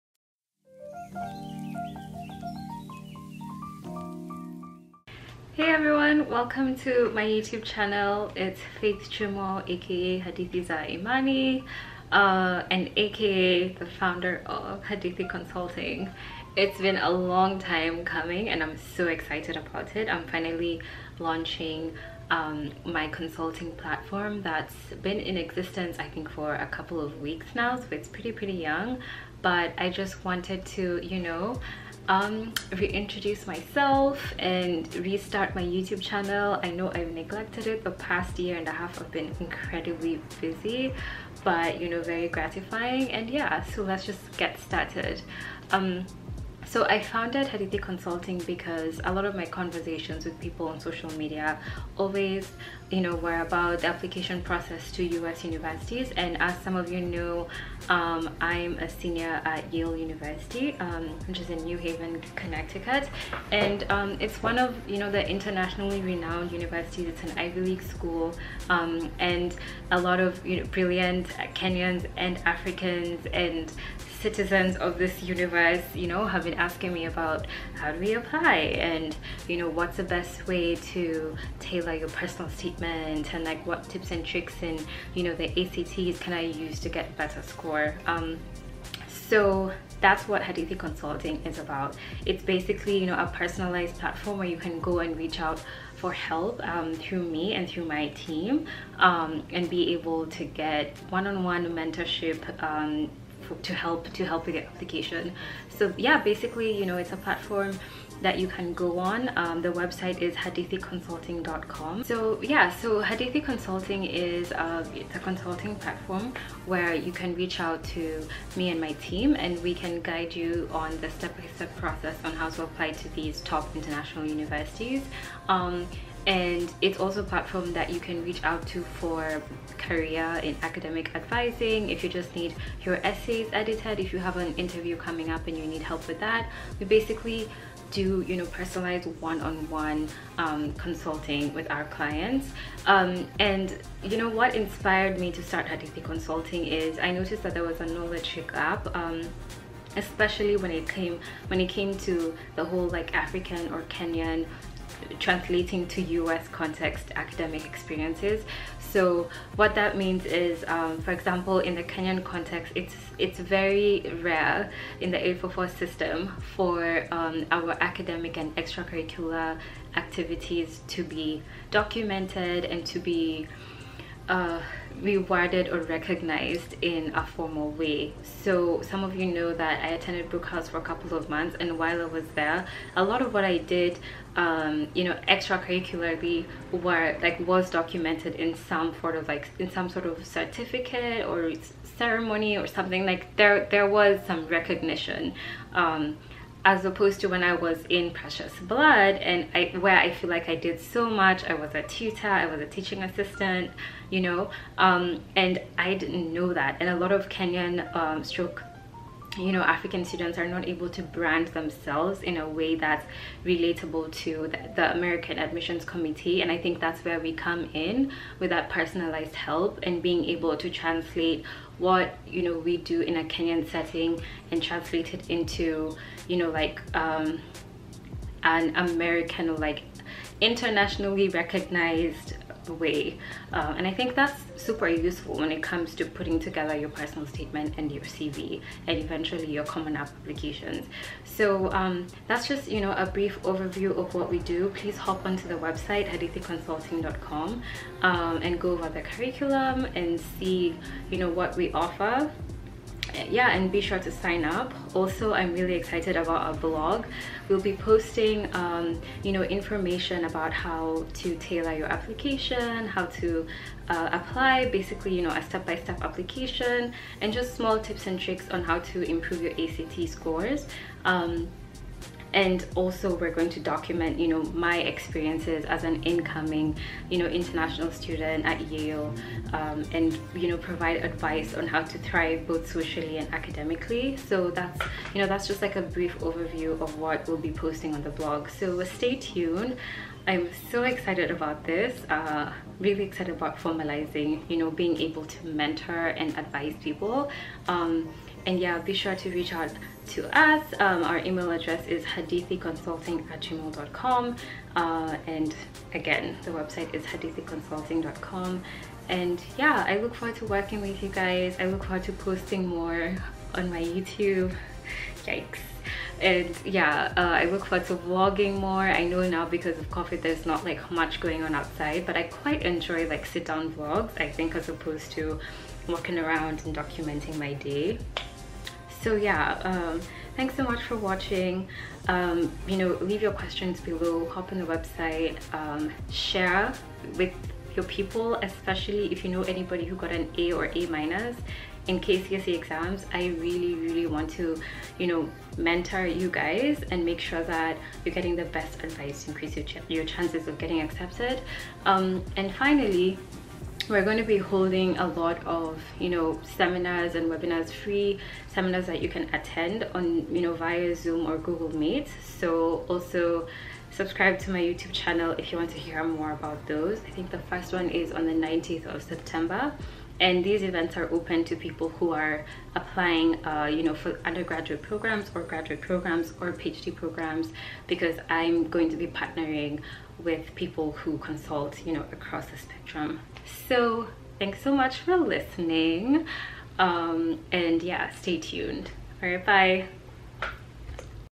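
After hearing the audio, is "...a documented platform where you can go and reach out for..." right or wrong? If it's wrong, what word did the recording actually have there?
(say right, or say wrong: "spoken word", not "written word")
wrong: "personalized", not "documented".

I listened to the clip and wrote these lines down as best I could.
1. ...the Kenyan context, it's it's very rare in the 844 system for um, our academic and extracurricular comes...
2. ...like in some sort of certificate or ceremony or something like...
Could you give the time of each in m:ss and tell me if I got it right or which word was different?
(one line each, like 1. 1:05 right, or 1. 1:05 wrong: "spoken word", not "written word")
1. 2:41 wrong: "activities", not "comes"
2. 3:09 right.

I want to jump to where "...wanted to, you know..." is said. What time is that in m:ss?
0:30.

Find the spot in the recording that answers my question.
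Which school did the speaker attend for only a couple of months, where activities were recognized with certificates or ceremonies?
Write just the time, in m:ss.
3:00.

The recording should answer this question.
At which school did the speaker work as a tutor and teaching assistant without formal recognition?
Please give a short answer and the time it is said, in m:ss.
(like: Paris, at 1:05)
Precious Blood, at 3:18.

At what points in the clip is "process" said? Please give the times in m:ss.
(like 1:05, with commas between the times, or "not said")
0:54, 2:01.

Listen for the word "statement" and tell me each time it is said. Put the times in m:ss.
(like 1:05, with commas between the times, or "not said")
1:22, 3:57.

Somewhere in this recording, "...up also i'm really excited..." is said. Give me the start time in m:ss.
4:14.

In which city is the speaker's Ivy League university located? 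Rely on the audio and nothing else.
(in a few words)
New Haven.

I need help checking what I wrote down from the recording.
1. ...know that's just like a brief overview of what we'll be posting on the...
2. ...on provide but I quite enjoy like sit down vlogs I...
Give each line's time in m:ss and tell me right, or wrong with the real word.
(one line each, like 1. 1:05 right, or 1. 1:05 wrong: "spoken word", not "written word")
1. 4:45 right
2. 5:21 wrong: "outside", not "provide".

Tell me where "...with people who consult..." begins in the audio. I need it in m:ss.
6:20.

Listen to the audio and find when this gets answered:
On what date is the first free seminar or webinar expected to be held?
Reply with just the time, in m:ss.
6:08.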